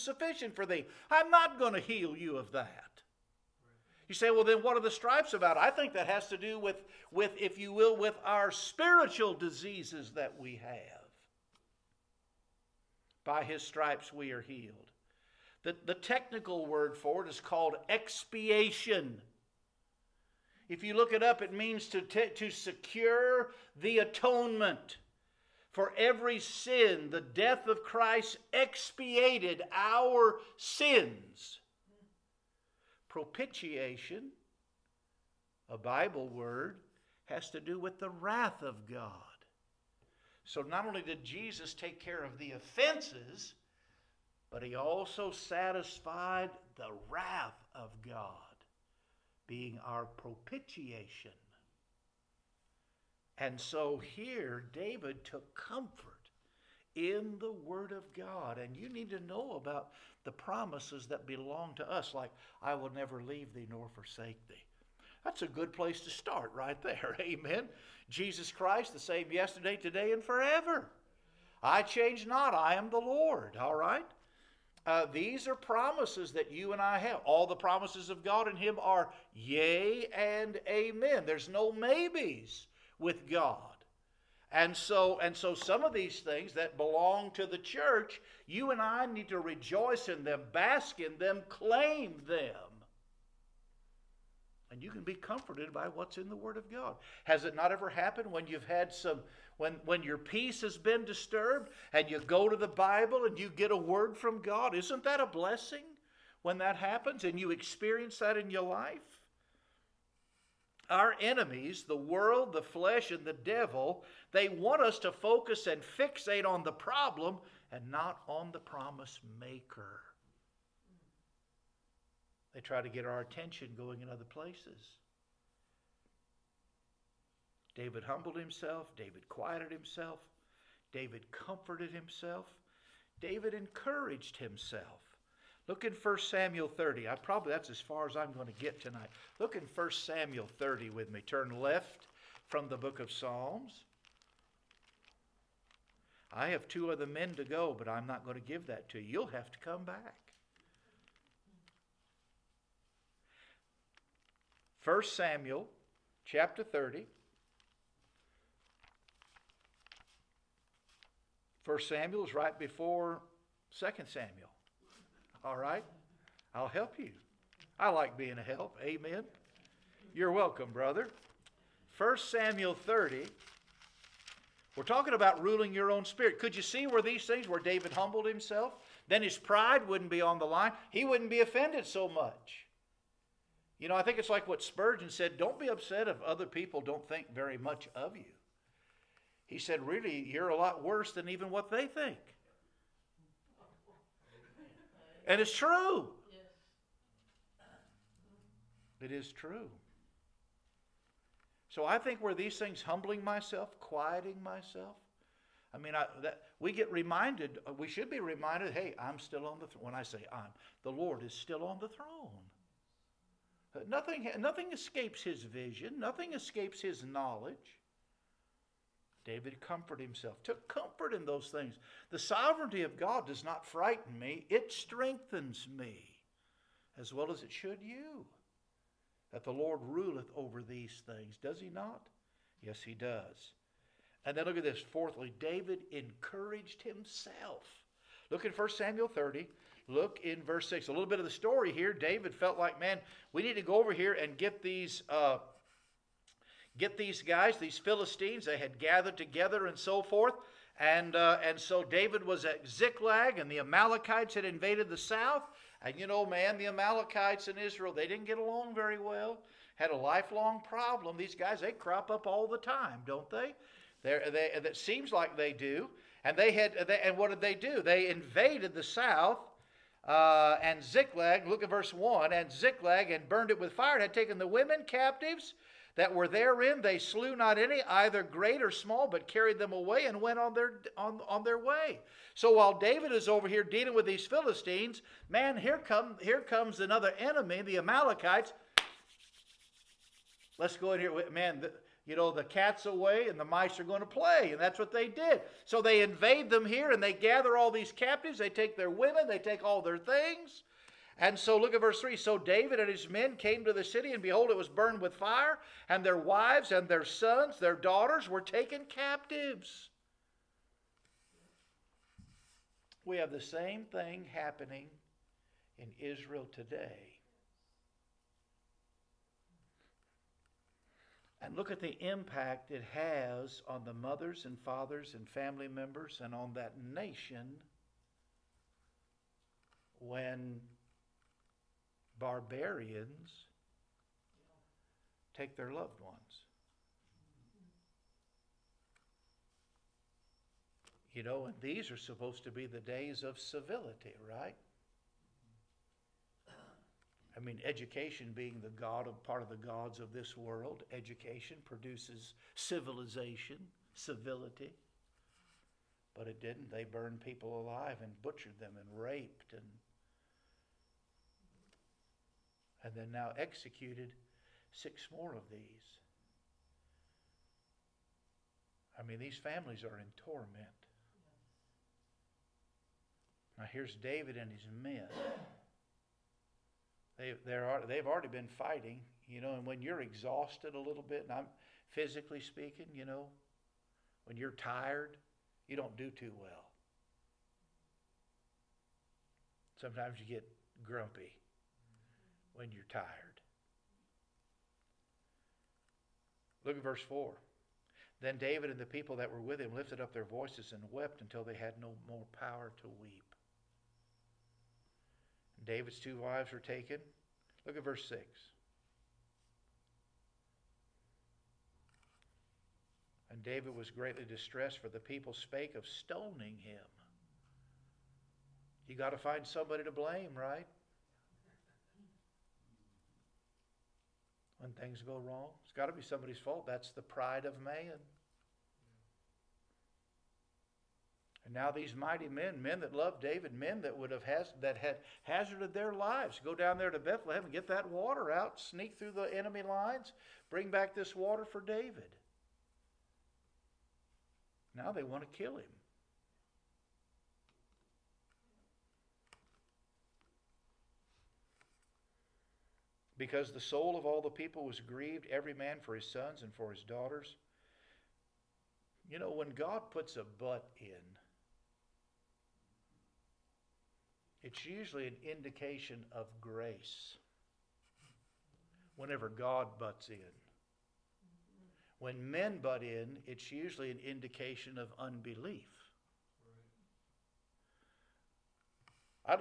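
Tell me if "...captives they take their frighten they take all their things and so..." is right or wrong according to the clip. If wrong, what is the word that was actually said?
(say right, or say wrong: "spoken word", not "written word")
wrong: "women", not "frighten".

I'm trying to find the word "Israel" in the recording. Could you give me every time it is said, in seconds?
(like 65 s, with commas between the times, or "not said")
257 s, 316 s.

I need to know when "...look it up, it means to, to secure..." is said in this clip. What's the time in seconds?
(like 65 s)
20 s.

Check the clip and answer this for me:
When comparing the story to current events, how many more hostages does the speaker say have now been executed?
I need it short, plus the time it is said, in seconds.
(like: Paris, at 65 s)
6, at 364 s.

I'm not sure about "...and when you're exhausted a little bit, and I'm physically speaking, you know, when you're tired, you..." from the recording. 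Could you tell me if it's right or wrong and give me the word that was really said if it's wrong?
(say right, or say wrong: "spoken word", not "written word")
right.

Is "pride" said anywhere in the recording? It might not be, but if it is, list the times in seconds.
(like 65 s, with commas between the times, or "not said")
179 s, 427 s.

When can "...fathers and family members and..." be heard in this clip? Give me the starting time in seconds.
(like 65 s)
324 s.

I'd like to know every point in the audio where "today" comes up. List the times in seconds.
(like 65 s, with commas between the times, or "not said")
69 s, 316 s.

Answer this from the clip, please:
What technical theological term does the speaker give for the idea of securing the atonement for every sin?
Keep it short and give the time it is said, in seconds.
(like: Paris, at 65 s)
expiation, at 17 s.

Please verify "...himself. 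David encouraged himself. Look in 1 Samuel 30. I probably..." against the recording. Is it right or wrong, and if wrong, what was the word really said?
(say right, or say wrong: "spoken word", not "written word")
right.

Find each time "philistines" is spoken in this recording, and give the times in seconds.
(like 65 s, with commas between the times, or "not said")
247 s, 284 s.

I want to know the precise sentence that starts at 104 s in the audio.
Isn't that a blessing when that happens and you experience that in your life?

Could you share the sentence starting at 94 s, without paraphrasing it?
And you can be comforted by what's in the Word of God.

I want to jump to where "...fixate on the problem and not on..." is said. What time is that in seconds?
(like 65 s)
115 s.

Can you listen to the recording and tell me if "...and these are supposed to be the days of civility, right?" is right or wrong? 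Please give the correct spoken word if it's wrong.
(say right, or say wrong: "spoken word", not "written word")
right.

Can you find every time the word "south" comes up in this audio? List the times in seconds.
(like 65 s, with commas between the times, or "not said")
254 s, 268 s.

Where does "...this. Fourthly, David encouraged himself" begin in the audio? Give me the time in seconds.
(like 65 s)
234 s.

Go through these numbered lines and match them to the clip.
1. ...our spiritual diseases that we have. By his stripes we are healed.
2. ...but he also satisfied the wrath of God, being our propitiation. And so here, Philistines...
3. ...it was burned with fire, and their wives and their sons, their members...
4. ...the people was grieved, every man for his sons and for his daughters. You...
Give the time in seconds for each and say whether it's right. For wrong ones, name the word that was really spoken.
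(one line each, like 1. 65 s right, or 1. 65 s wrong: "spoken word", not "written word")
1. 8 s right
2. 44 s wrong: "David", not "Philistines"
3. 304 s wrong: "daughters", not "members"
4. 454 s right.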